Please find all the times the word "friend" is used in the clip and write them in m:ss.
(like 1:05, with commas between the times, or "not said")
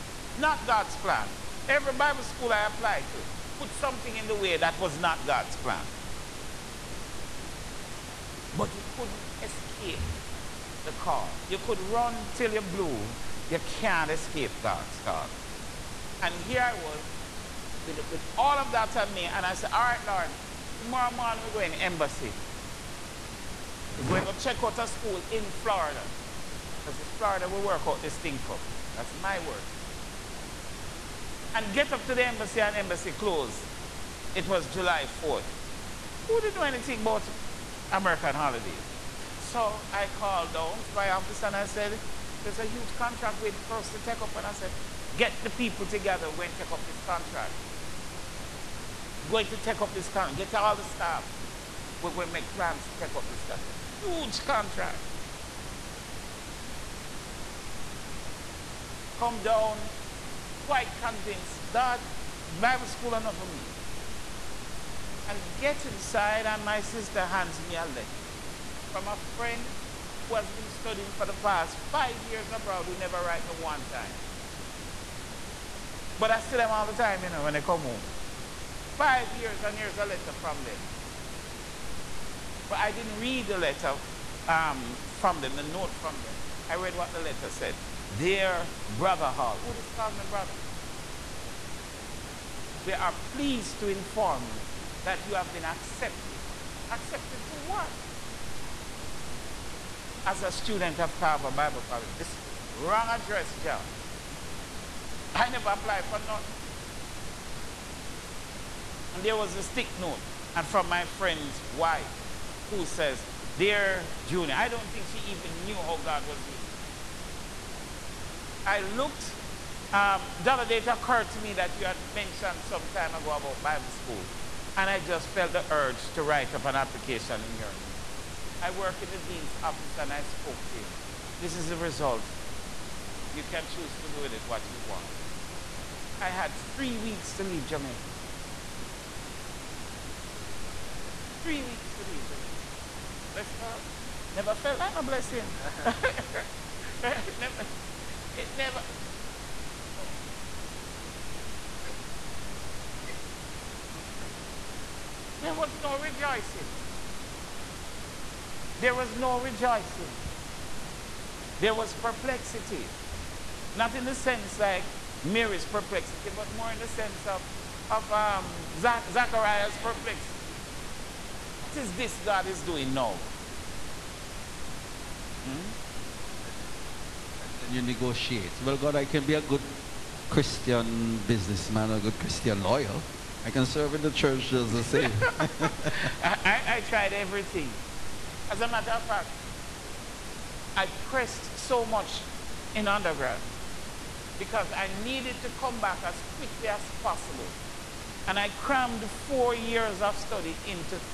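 1:09, 1:51.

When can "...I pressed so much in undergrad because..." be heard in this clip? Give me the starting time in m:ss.
3:10.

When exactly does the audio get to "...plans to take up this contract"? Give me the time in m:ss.
0:52.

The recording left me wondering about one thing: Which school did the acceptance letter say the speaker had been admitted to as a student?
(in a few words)
Carver Bible College.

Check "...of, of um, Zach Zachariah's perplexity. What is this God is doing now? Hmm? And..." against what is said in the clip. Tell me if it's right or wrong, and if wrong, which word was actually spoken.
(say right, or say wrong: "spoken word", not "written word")
right.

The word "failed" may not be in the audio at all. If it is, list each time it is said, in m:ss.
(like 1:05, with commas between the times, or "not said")
not said.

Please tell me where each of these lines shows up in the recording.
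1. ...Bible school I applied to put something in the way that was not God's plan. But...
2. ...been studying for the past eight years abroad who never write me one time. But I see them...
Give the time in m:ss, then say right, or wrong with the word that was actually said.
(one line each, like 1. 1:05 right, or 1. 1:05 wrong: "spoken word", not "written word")
1. 0:01 right
2. 1:10 wrong: "five", not "eight".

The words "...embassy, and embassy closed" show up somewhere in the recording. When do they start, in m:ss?
0:32.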